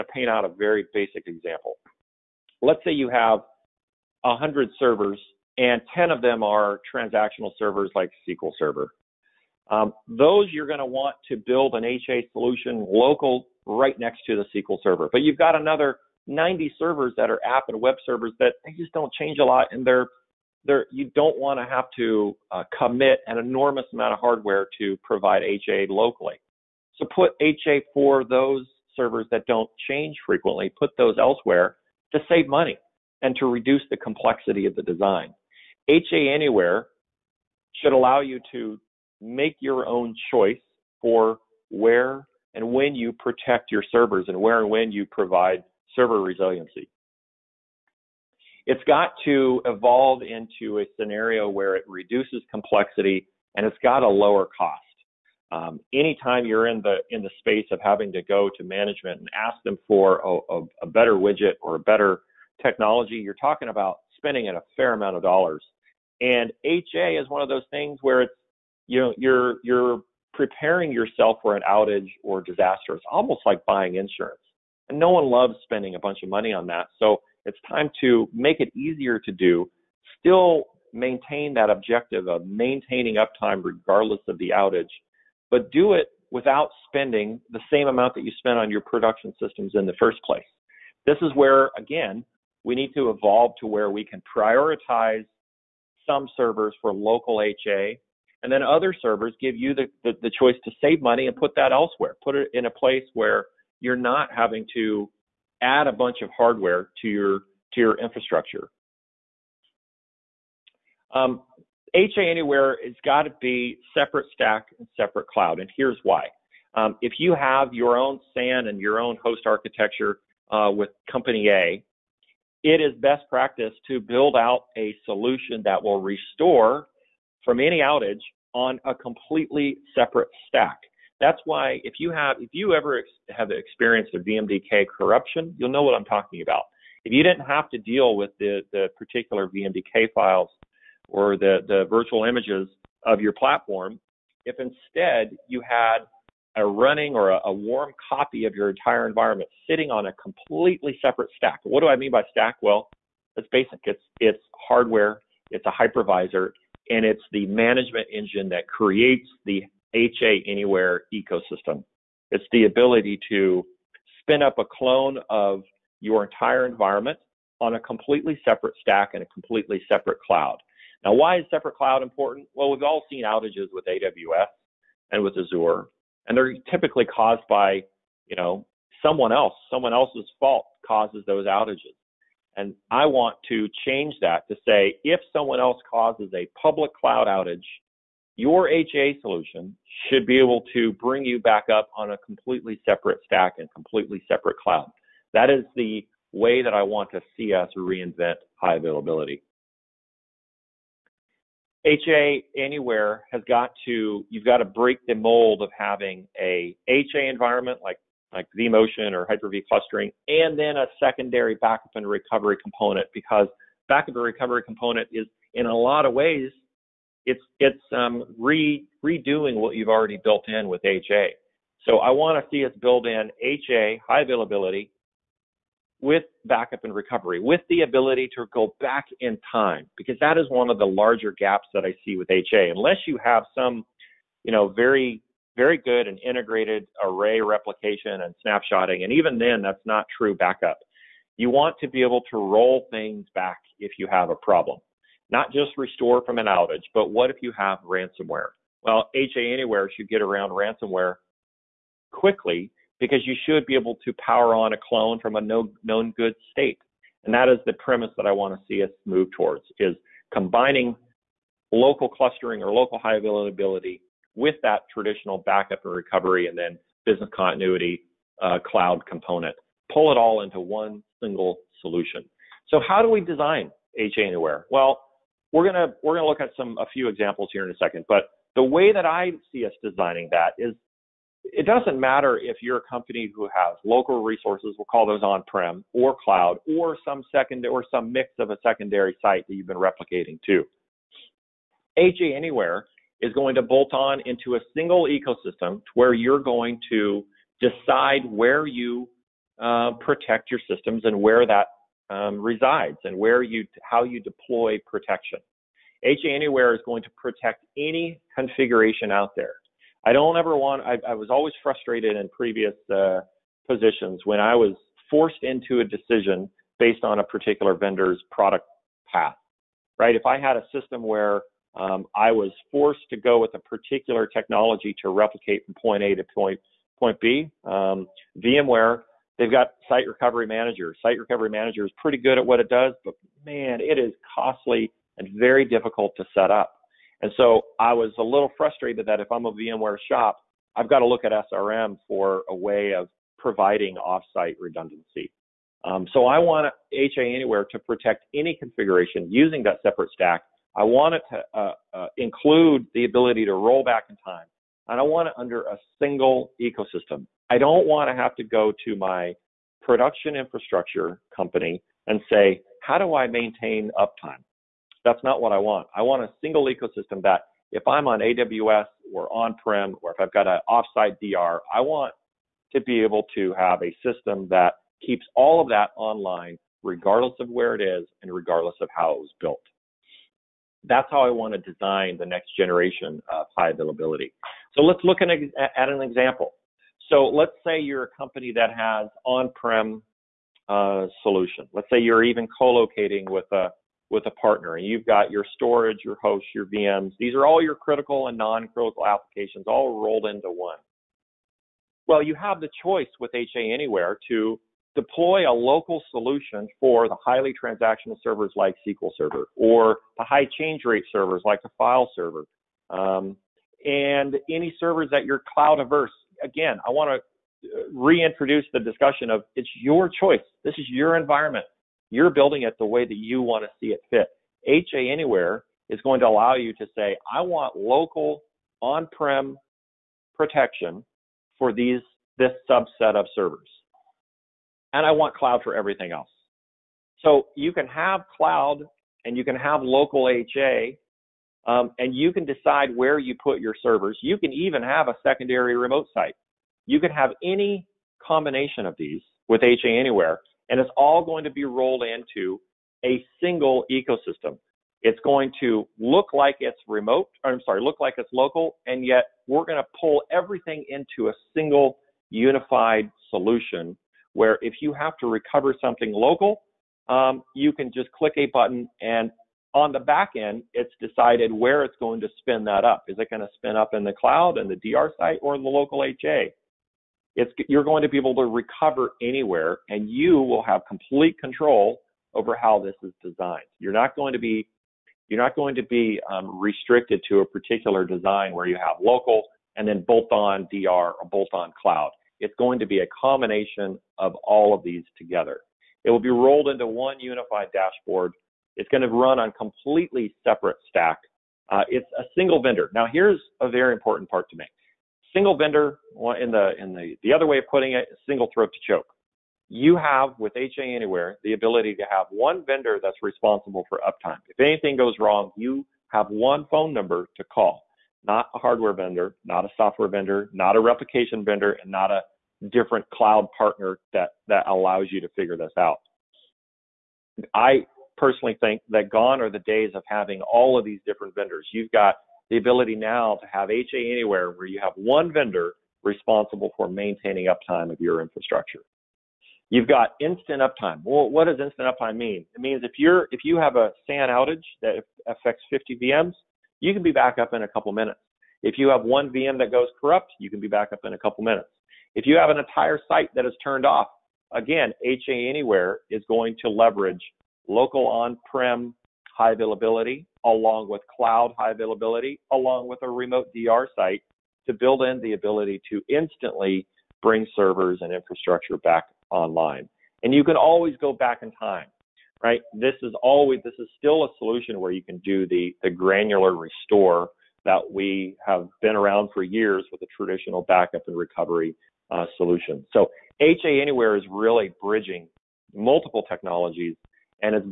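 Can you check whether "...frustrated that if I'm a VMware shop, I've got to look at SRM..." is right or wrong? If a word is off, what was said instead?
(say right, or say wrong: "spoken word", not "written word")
right.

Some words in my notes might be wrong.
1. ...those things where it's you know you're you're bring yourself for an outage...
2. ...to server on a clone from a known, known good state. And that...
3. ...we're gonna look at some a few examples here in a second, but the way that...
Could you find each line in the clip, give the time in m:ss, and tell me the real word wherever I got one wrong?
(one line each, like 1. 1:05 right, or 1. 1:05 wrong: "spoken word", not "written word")
1. 1:07 wrong: "preparing", not "bring"
2. 4:14 wrong: "power", not "server"
3. 4:36 right.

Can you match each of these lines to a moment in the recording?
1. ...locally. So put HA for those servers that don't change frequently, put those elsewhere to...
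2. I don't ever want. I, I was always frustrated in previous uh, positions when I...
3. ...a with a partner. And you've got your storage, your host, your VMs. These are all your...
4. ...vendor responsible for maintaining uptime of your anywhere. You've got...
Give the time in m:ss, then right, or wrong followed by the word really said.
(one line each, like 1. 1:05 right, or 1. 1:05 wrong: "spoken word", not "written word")
1. 0:25 right
2. 5:10 right
3. 6:33 right
4. 8:55 wrong: "infrastructure", not "anywhere".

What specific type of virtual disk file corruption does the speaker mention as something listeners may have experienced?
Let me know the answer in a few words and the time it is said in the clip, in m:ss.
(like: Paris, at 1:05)
VMDK corruption, at 2:14.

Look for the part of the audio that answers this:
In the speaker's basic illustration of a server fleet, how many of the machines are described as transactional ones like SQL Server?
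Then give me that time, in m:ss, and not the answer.
0:05.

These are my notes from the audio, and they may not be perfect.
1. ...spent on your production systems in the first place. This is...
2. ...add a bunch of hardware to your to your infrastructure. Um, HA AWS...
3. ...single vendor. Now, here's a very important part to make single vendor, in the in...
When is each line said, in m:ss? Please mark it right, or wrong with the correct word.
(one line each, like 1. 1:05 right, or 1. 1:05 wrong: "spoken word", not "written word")
1. 1:28 right
2. 1:45 wrong: "Anywhere", not "AWS"
3. 8:22 right.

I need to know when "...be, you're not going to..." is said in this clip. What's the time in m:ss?
8:04.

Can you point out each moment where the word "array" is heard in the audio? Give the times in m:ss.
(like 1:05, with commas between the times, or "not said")
3:57.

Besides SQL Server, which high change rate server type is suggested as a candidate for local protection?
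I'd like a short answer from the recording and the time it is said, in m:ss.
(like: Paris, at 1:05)
File server, at 6:51.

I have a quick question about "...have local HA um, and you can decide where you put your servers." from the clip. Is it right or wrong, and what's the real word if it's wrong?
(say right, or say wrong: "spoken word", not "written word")
right.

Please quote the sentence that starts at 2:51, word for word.
Now, why is separate cloud important?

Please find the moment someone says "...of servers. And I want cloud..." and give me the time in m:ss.
7:13.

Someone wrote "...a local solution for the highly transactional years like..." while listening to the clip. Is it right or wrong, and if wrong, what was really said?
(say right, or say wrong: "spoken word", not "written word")
wrong: "servers", not "years".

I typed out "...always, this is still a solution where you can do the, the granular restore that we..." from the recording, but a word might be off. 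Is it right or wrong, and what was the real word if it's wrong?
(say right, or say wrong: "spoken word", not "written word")
right.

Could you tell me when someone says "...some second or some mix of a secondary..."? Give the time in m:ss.
4:47.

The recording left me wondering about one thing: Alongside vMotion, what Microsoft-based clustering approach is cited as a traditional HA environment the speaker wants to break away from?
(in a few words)
Hyper-V clustering.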